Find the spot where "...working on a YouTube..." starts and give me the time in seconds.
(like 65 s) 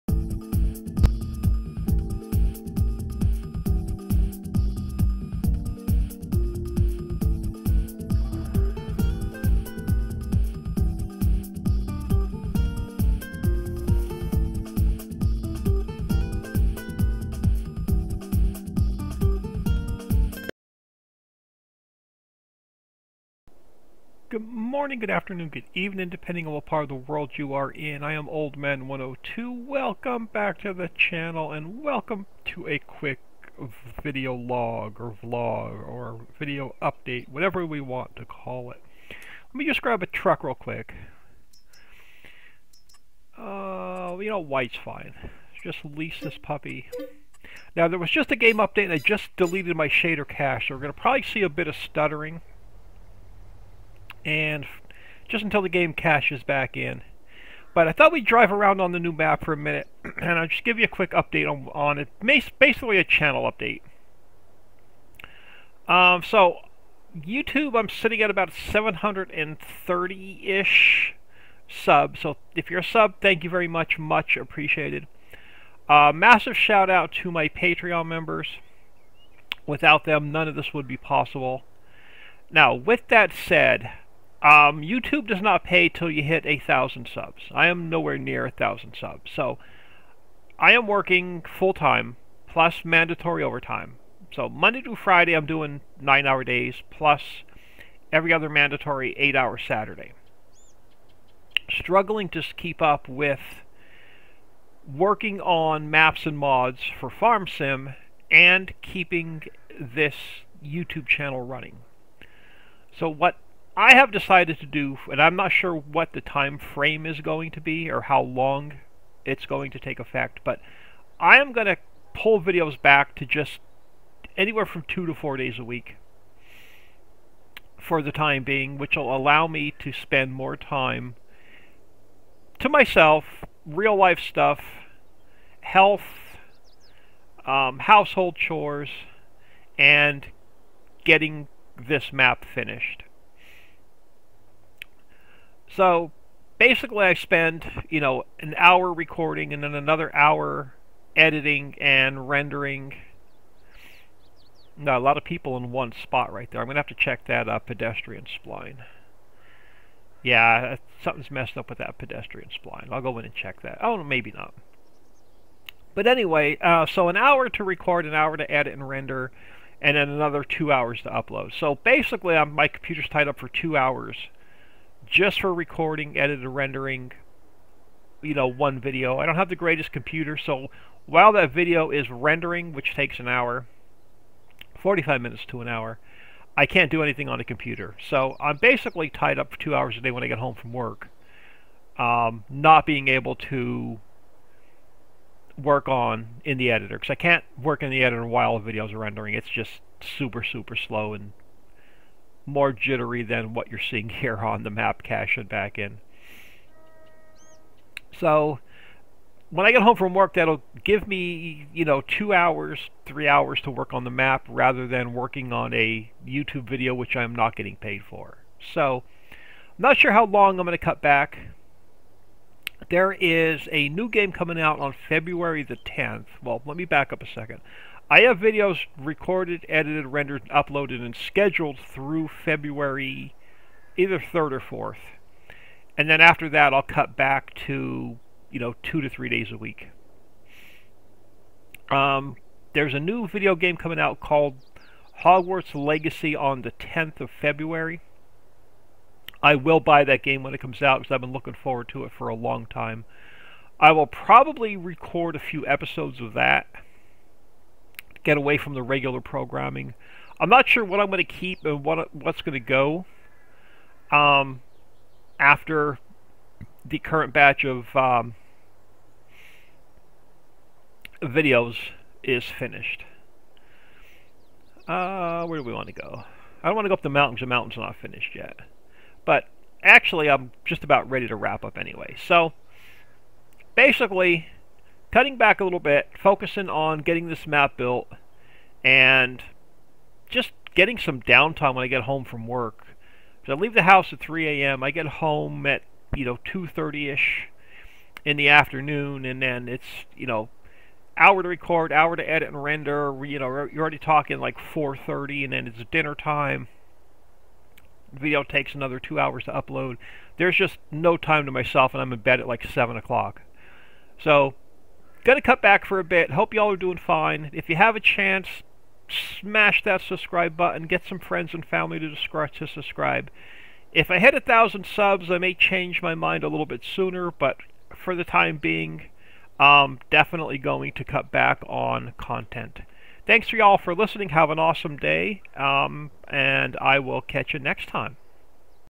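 215 s.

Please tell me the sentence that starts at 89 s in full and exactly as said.
So I am working full time plus mandatory overtime.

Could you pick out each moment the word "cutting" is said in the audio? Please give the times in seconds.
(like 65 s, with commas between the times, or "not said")
285 s.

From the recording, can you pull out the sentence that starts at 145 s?
So basically I spend, you know, an hour recording and then another hour editing and rendering.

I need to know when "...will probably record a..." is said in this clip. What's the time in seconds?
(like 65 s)
253 s.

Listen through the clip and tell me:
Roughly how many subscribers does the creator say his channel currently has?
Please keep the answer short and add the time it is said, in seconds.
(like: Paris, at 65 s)
730, at 68 s.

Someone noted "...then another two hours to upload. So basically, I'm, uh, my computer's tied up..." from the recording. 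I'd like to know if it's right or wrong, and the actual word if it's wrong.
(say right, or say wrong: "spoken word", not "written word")
right.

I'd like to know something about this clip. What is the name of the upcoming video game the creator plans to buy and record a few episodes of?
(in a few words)
Hogwarts Legacy.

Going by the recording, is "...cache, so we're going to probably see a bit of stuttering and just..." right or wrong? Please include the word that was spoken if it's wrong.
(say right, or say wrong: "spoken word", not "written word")
right.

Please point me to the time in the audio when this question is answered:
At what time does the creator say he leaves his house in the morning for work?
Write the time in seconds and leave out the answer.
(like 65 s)
294 s.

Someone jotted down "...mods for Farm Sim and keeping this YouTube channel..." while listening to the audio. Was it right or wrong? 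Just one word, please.
right.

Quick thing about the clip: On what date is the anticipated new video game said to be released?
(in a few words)
February 10.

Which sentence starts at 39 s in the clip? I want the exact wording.
Let me just grab a truck real quick.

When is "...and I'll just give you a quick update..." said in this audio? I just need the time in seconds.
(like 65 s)
60 s.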